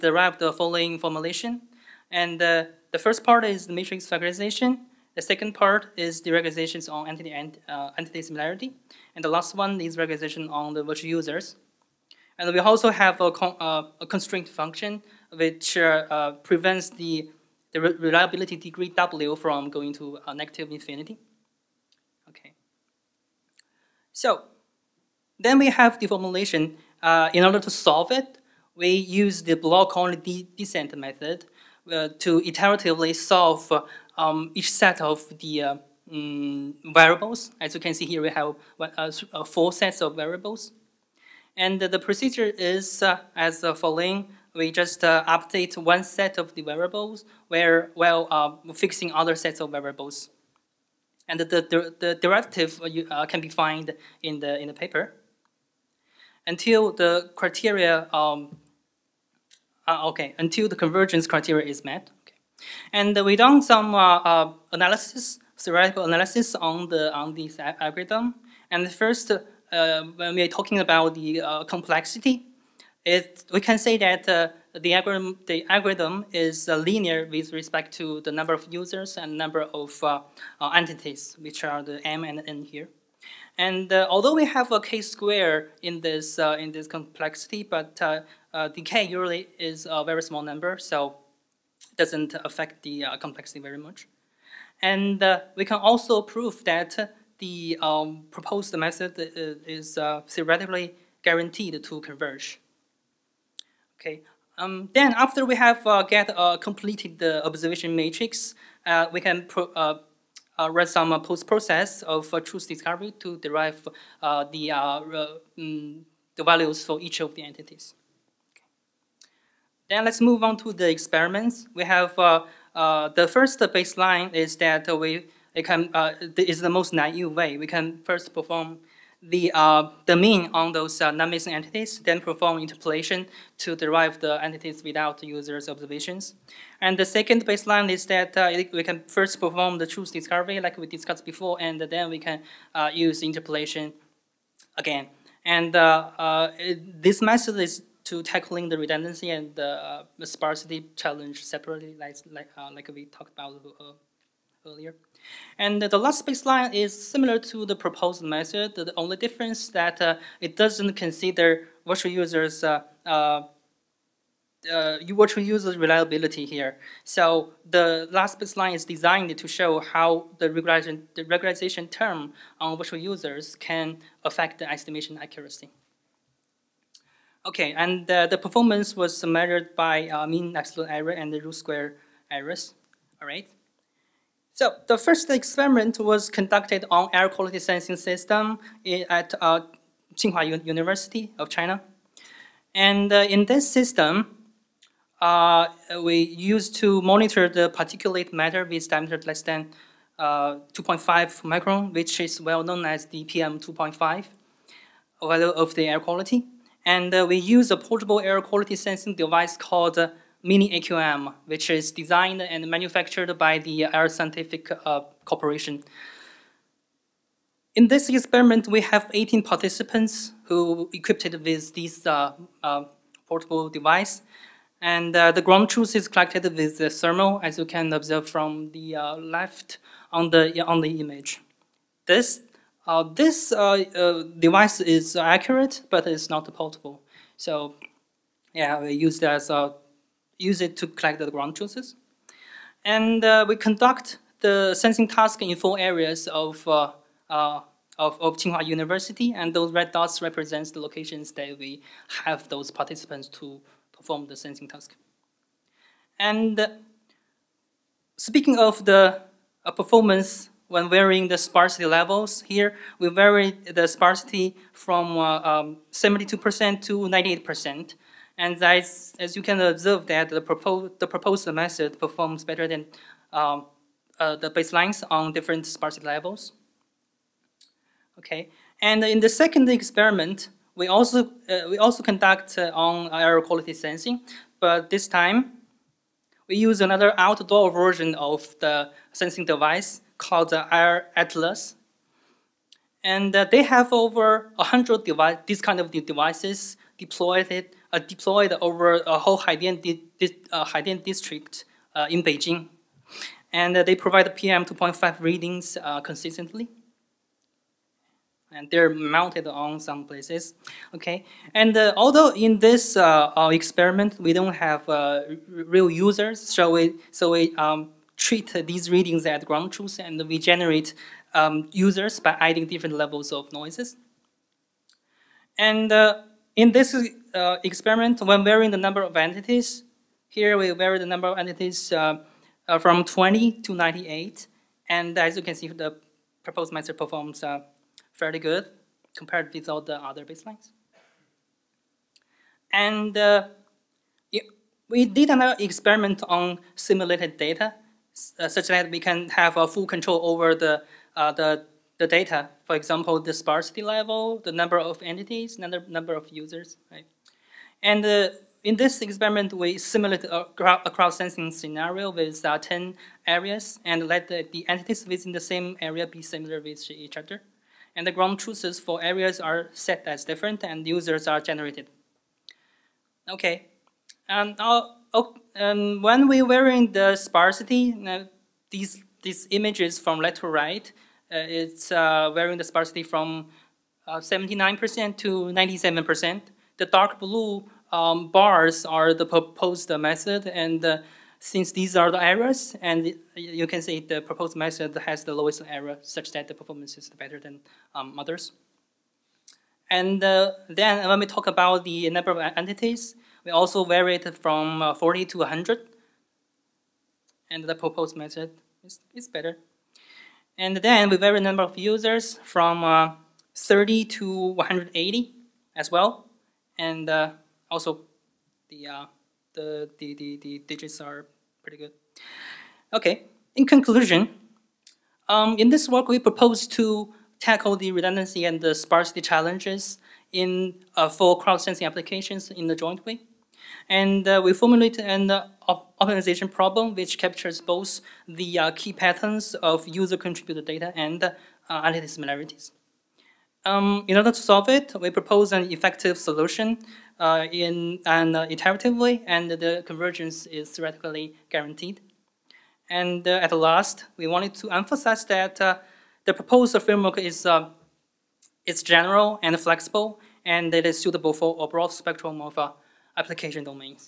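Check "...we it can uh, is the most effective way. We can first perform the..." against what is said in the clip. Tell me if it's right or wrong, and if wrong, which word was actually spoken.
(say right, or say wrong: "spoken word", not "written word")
wrong: "naive", not "effective".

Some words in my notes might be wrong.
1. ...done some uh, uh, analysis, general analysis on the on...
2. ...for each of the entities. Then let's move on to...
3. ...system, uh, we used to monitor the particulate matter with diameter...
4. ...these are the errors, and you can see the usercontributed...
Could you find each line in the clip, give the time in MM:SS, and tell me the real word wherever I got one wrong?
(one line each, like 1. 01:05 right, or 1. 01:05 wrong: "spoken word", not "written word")
1. 01:03 wrong: "theoretical", not "general"
2. 01:56 right
3. 03:13 right
4. 06:31 wrong: "proposed", not "usercontributed".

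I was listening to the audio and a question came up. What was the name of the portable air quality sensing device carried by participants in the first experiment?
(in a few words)
Mini AQM.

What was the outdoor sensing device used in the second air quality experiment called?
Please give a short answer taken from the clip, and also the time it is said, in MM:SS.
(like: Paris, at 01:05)
Air Atlas, at 04:50.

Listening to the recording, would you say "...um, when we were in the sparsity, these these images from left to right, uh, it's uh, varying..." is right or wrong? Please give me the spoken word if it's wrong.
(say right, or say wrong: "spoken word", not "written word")
right.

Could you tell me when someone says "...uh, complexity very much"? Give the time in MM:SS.
01:33.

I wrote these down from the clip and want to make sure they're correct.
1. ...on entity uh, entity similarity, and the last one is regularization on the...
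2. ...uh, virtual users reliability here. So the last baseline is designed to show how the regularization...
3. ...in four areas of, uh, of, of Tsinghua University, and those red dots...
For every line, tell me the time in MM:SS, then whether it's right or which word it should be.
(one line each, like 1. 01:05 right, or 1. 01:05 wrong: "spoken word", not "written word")
1. 00:06 right
2. 02:44 right
3. 04:05 right.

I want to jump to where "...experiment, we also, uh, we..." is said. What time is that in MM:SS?
04:39.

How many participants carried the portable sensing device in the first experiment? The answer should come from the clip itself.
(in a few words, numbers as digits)
18.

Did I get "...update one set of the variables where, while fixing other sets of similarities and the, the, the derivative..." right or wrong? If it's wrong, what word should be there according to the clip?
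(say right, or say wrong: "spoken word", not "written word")
wrong: "variables", not "similarities".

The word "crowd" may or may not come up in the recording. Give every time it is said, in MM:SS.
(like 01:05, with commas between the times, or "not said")
06:00, 07:11.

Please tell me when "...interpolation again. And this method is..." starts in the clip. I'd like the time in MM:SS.
02:23.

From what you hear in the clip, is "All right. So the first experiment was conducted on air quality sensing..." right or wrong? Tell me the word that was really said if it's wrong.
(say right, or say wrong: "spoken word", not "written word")
right.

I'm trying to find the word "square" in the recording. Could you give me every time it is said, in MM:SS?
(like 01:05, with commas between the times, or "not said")
01:25, 03:01.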